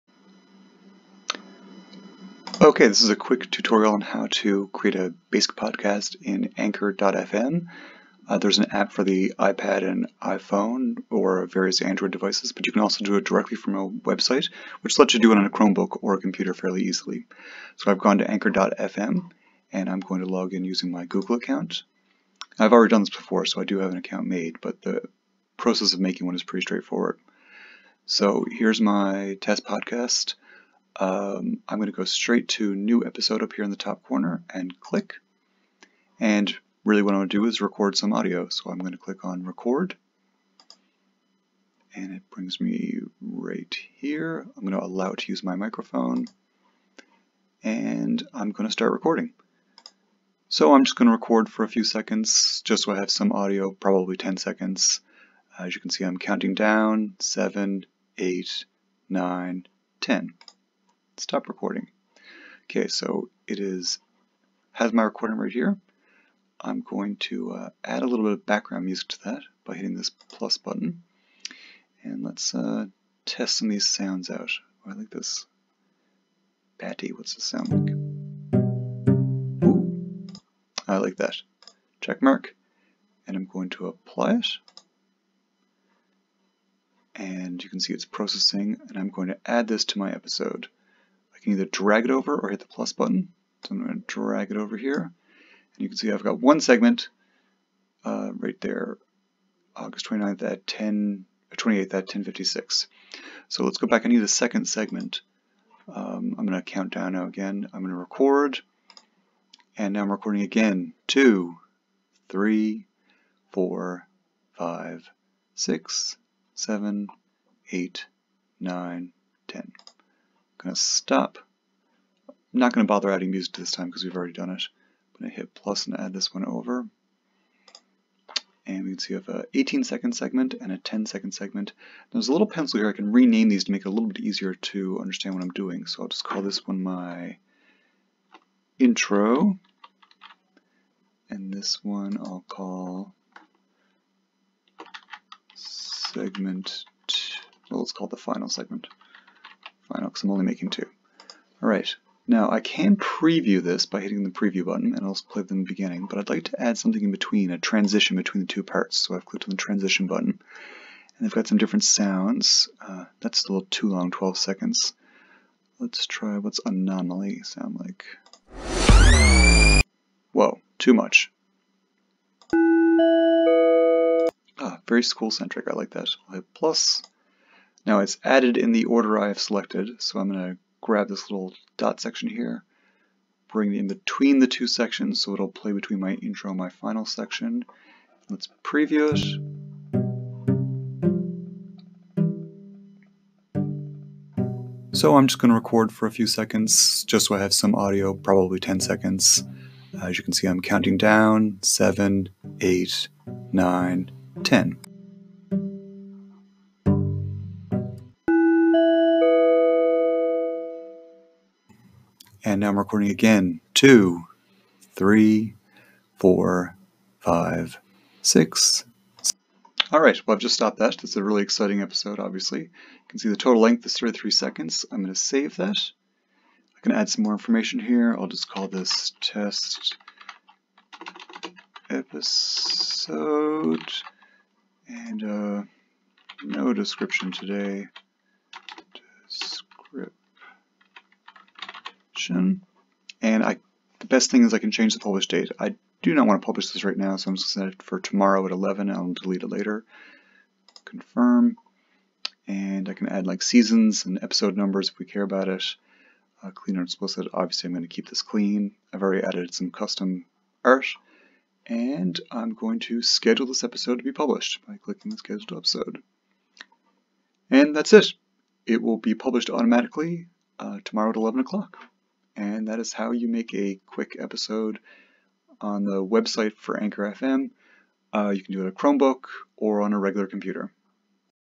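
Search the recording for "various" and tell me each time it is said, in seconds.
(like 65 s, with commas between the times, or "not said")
11 s.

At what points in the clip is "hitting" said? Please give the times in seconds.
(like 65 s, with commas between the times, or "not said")
69 s, 154 s.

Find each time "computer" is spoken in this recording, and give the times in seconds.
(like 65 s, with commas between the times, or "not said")
16 s, 280 s.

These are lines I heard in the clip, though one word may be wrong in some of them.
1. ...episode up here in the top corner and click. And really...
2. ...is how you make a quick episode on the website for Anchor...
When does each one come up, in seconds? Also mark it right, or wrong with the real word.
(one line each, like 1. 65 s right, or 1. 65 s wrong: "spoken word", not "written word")
1. 33 s right
2. 272 s right.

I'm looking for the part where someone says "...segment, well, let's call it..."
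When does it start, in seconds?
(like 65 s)
145 s.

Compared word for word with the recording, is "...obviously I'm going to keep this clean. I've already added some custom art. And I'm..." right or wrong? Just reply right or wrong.
right.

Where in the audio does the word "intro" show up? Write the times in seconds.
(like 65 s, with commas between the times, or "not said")
138 s, 186 s.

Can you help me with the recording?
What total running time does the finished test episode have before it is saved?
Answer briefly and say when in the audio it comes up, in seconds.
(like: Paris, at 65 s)
33 seconds, at 223 s.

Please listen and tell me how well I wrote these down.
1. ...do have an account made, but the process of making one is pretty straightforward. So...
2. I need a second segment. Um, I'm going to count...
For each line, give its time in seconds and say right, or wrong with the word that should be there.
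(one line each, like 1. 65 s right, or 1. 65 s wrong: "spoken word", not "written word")
1. 23 s right
2. 104 s right.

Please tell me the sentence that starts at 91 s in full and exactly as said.
I can either drag it over or hit the plus button.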